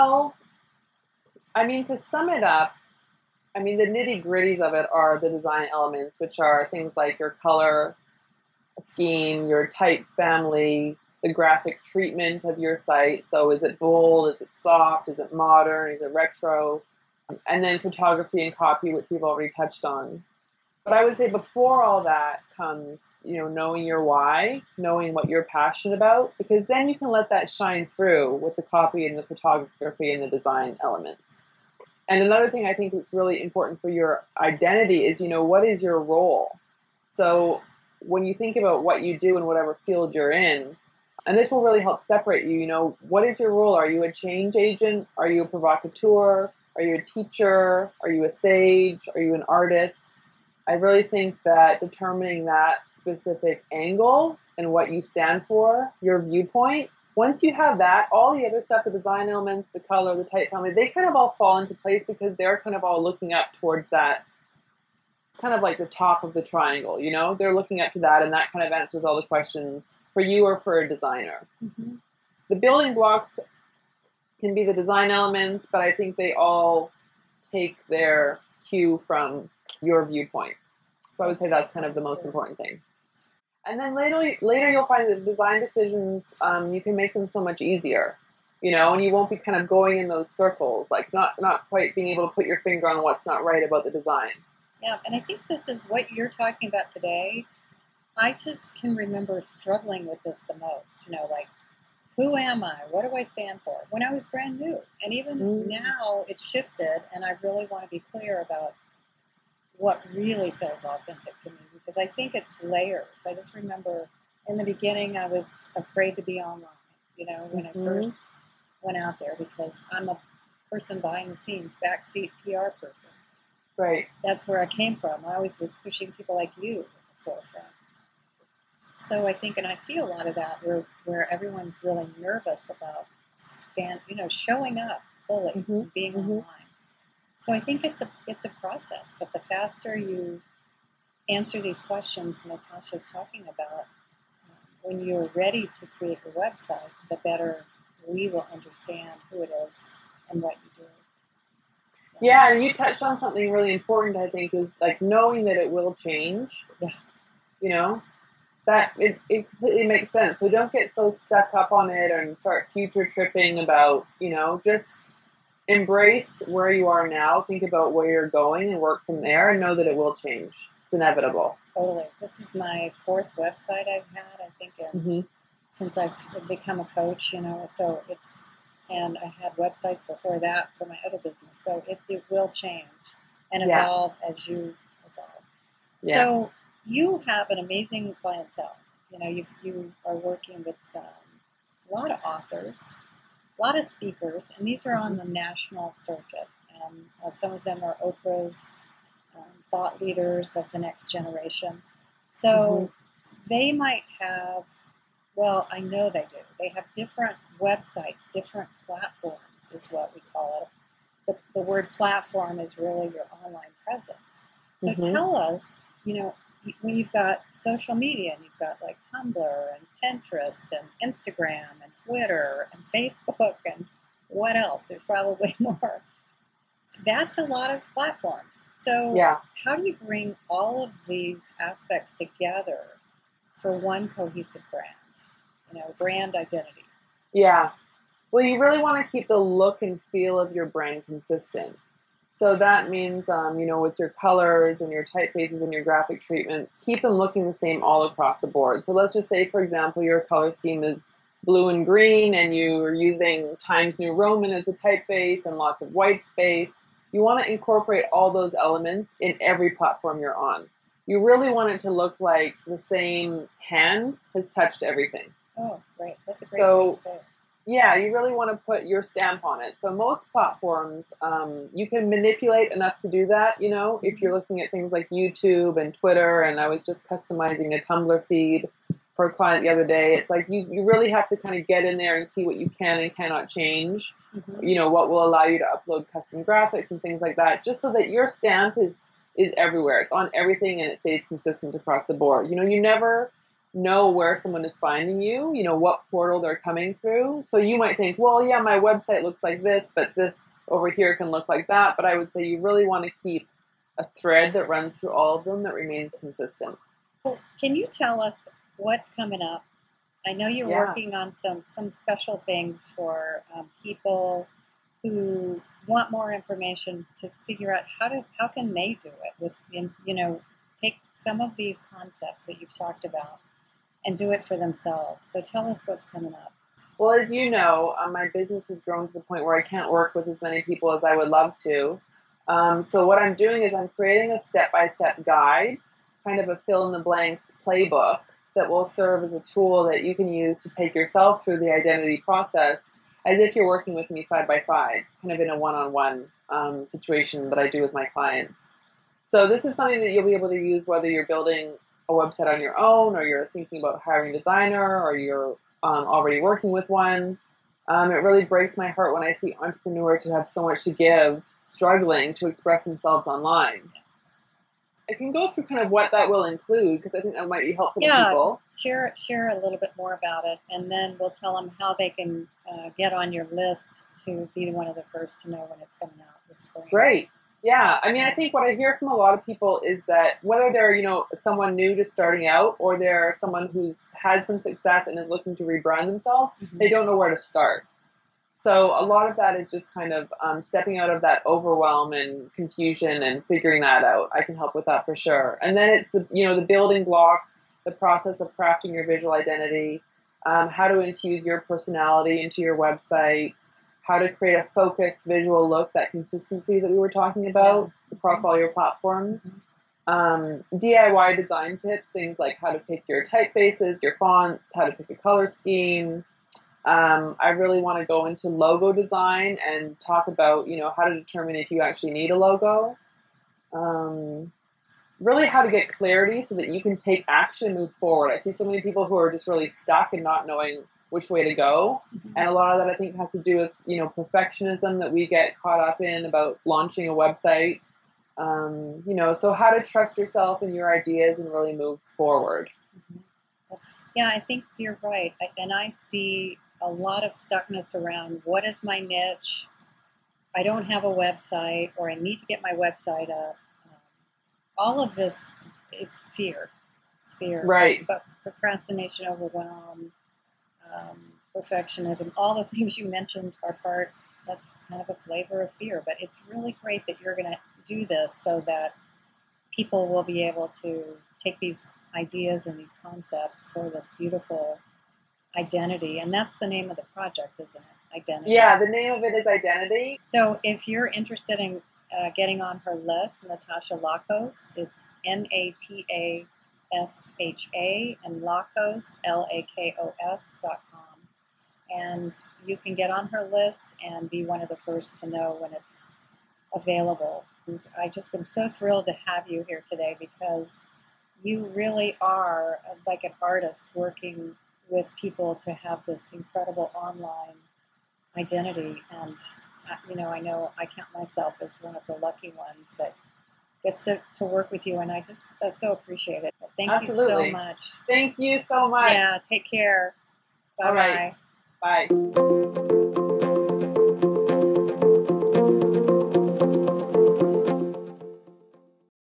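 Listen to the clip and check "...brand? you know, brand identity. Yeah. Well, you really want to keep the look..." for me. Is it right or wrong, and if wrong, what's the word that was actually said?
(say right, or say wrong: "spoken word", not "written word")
right.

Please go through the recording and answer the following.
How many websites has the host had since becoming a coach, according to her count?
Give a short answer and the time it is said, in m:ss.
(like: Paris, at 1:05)
4, at 2:53.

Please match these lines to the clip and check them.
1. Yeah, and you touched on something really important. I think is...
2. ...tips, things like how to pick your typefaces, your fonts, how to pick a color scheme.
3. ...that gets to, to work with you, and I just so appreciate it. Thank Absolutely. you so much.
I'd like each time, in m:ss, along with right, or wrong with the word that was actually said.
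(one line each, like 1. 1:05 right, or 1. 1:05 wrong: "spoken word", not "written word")
1. 2:32 right
2. 6:51 right
3. 8:32 right.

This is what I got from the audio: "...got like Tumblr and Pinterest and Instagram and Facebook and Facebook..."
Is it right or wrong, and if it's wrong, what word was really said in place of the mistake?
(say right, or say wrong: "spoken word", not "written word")
wrong: "Twitter", not "Facebook".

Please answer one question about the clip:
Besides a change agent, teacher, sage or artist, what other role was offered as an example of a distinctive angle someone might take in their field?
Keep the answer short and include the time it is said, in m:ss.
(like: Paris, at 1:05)
Provocateur, at 0:45.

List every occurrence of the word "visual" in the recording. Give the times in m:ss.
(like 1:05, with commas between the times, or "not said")
6:39, 6:45.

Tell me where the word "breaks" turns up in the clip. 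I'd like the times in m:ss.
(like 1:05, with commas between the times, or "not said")
5:58.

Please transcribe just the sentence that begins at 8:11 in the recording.
And you can get on her list and be one of the first to know when it's available.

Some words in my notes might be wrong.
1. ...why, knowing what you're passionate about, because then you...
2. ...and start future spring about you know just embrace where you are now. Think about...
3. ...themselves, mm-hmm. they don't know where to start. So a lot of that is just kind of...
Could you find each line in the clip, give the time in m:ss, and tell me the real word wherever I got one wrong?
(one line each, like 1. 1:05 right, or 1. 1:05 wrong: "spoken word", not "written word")
1. 0:24 right
2. 2:42 wrong: "tripping", not "spring"
3. 6:26 right.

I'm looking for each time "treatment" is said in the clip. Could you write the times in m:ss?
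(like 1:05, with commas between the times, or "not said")
0:11, 4:06.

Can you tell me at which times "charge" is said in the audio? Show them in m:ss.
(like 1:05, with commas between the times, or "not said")
not said.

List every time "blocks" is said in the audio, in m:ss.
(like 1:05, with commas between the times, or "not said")
1:12, 6:37.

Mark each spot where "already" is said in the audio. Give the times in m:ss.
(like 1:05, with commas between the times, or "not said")
0:19, 5:56.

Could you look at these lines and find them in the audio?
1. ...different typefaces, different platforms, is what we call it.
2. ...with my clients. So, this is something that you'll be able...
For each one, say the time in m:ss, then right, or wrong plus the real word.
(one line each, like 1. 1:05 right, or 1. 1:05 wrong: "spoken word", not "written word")
1. 3:26 wrong: "websites", not "typefaces"
2. 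5:47 right.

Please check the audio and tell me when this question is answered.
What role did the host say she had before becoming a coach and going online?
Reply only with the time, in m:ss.
2:01.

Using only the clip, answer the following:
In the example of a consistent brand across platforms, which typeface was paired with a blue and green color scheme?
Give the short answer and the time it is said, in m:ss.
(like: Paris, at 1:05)
Times New Roman, at 4:13.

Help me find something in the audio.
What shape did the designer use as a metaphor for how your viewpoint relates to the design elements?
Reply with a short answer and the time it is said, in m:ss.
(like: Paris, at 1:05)
Triangle, at 1:06.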